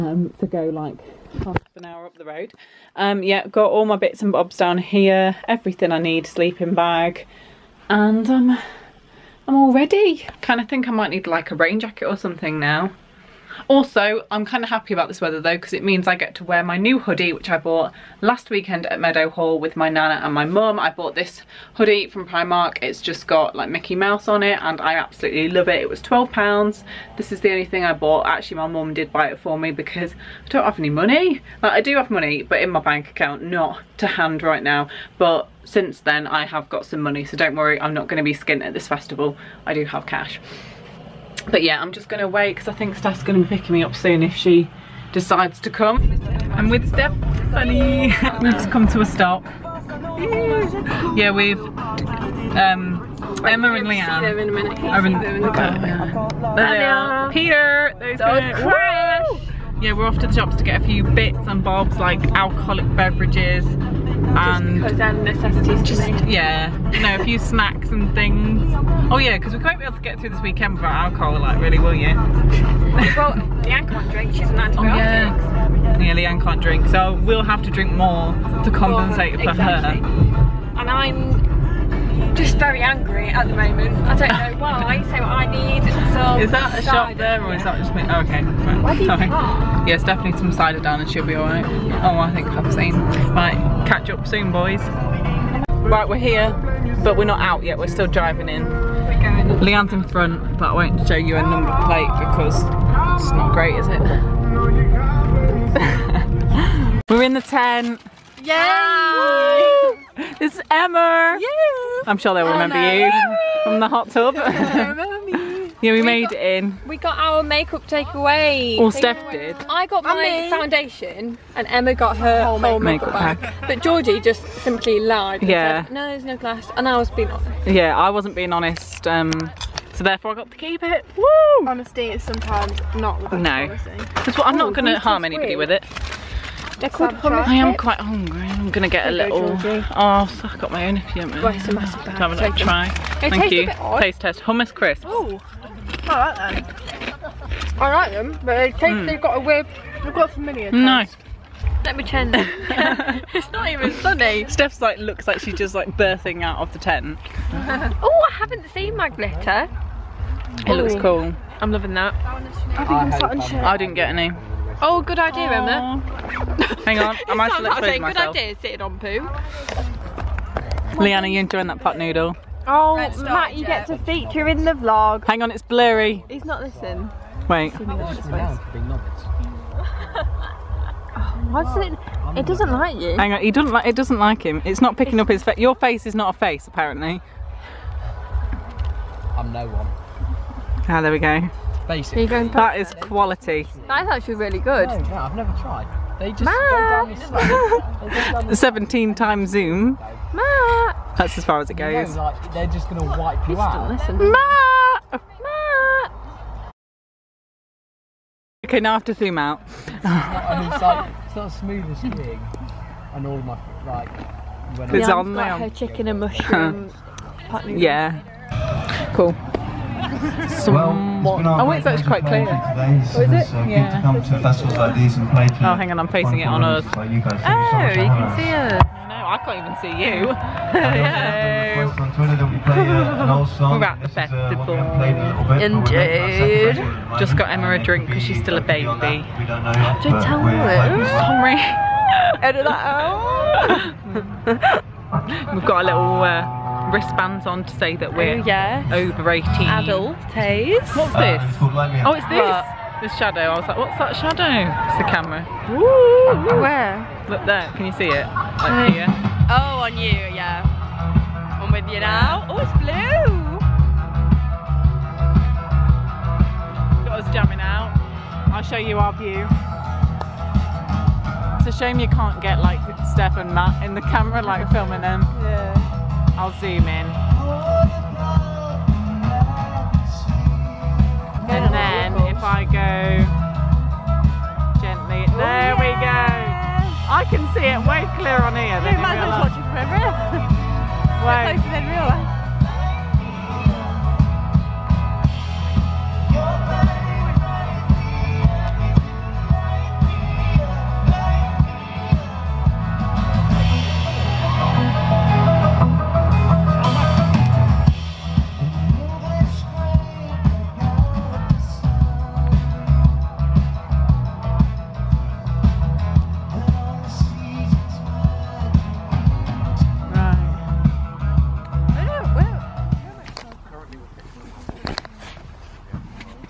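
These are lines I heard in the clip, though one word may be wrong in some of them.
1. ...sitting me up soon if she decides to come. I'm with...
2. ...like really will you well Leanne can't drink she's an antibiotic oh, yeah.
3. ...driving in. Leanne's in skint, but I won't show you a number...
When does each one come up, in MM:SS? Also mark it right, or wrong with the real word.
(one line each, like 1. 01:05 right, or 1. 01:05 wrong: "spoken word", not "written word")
1. 00:43 wrong: "picking", not "sitting"
2. 01:11 right
3. 01:38 wrong: "front", not "skint".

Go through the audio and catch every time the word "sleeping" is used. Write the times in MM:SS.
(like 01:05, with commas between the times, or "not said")
00:06.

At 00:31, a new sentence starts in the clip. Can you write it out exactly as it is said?
Like, I do have money but in my bank account, not to hand right now.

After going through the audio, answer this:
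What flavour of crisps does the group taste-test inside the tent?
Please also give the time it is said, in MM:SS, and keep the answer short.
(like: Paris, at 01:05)
Hummus, at 02:24.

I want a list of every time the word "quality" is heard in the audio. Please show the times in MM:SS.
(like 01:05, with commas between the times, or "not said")
03:13.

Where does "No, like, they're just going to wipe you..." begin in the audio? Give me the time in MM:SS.
03:22.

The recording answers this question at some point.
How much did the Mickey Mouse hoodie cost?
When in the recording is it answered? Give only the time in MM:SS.
00:26.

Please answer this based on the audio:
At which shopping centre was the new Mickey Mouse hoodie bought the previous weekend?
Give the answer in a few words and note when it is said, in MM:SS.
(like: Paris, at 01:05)
Meadowhall, at 00:18.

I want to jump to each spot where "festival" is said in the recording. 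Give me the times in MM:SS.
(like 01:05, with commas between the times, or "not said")
00:38, 03:44, 03:54.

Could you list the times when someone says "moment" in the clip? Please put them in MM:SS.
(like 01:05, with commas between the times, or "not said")
01:23.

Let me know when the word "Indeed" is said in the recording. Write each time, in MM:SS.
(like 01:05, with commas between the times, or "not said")
03:55.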